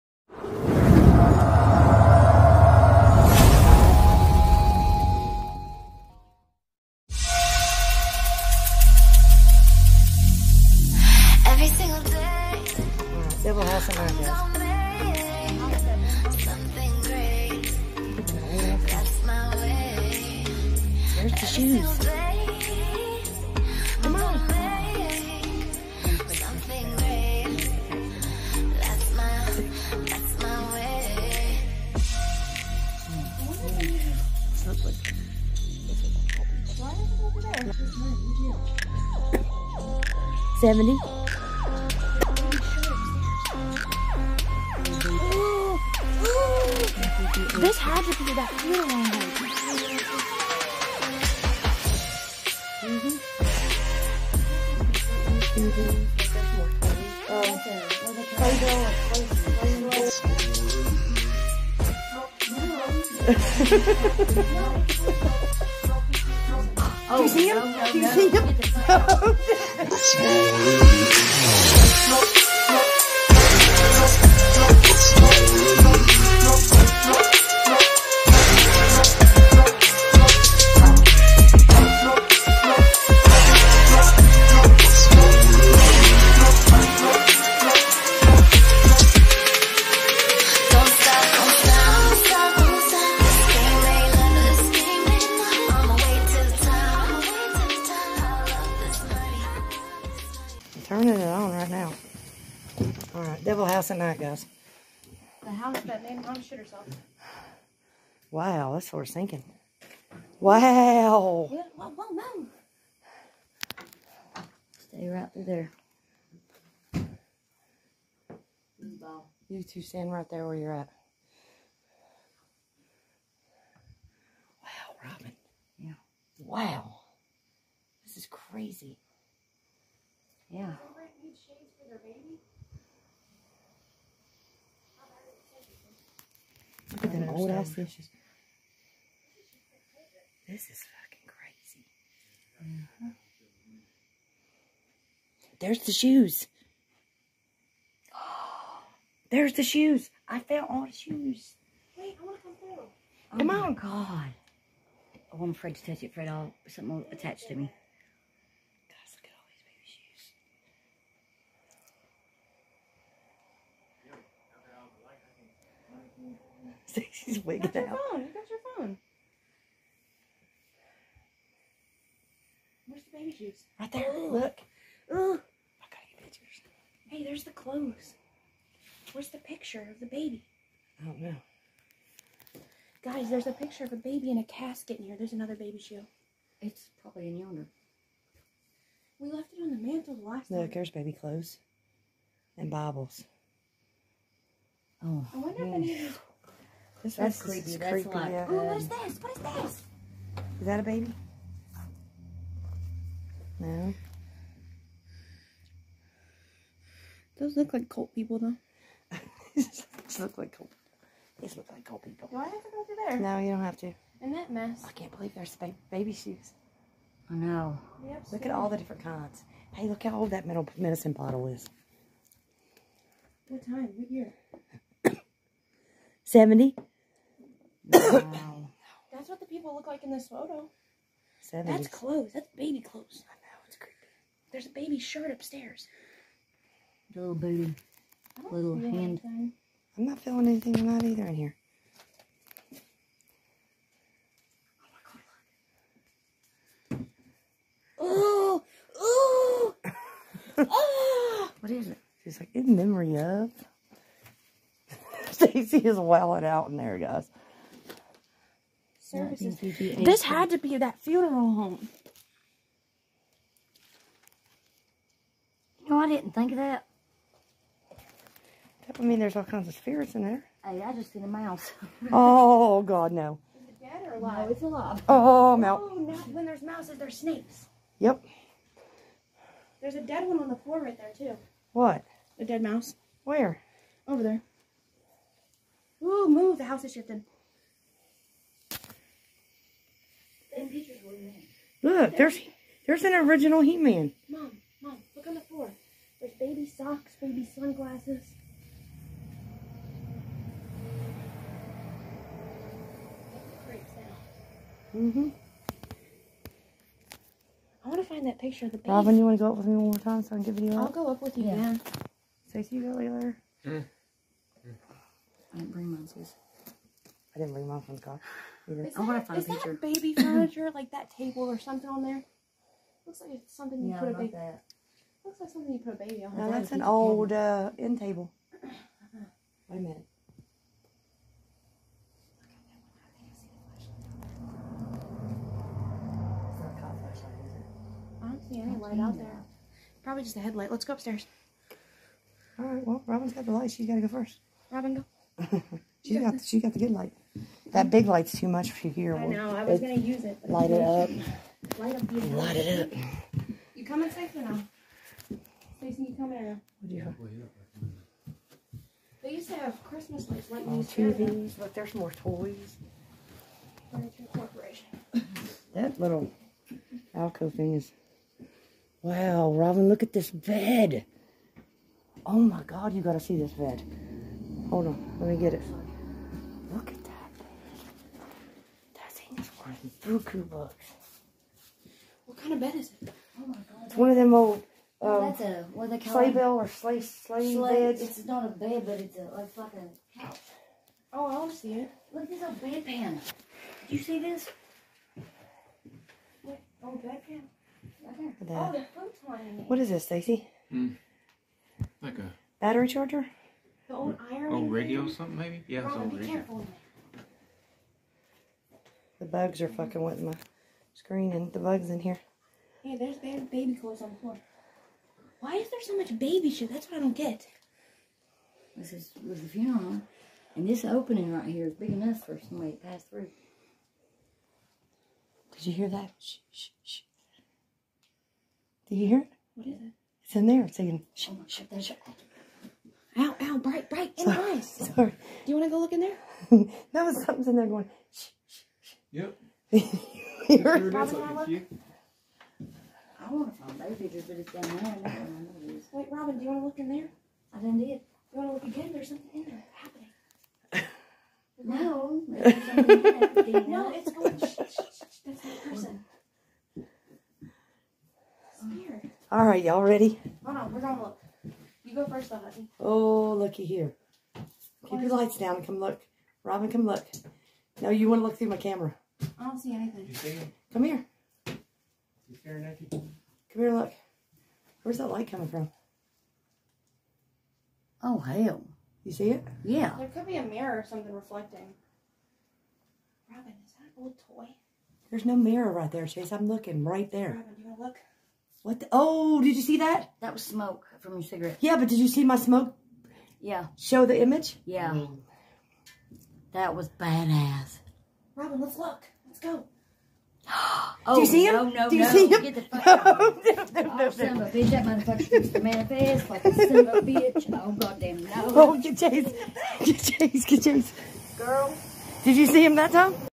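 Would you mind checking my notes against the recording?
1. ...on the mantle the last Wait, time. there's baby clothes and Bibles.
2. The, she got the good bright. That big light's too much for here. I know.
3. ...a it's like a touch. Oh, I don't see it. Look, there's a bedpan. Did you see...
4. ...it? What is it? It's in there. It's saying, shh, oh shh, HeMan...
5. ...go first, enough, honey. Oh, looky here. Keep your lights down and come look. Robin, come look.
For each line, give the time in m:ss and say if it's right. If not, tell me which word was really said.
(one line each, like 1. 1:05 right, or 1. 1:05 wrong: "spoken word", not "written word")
1. 3:09 wrong: "Look", not "Wait"
2. 5:46 wrong: "light", not "bright"
3. 6:29 wrong: "couch", not "touch"
4. 7:09 wrong: "God", not "HeMan"
5. 7:41 wrong: "though", not "enough".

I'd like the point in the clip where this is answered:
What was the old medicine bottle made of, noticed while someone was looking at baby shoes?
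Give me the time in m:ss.
3:40.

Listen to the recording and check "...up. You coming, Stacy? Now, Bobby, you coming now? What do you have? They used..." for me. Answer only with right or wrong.
wrong.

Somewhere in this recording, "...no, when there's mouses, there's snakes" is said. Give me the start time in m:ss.
4:35.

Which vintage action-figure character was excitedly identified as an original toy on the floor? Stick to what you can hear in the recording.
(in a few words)
He-Man.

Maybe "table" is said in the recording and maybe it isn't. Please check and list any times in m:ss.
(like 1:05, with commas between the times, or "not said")
5:21, 5:27.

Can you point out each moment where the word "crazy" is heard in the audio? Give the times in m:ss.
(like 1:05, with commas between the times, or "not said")
2:08, 2:21.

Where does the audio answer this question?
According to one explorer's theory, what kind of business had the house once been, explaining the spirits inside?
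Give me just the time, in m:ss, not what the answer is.
4:21.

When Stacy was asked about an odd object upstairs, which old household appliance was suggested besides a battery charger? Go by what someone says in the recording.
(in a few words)
iron.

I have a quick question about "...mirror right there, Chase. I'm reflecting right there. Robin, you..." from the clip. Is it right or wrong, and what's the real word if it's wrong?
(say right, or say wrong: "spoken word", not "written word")
wrong: "looking", not "reflecting".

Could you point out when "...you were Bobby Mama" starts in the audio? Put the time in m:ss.
7:19.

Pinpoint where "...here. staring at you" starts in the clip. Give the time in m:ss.
7:50.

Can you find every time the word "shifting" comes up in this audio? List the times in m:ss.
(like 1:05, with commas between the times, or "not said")
4:46.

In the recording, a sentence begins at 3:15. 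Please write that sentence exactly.
if any of these this that's creepy.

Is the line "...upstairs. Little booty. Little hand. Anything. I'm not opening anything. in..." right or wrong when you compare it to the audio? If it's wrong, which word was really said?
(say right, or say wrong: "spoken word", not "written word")
wrong: "feeling", not "opening".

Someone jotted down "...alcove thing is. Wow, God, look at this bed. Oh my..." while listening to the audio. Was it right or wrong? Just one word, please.
wrong.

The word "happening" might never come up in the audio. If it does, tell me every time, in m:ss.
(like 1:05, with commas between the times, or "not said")
7:29.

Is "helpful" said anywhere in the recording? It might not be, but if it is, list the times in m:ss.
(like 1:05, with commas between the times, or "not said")
not said.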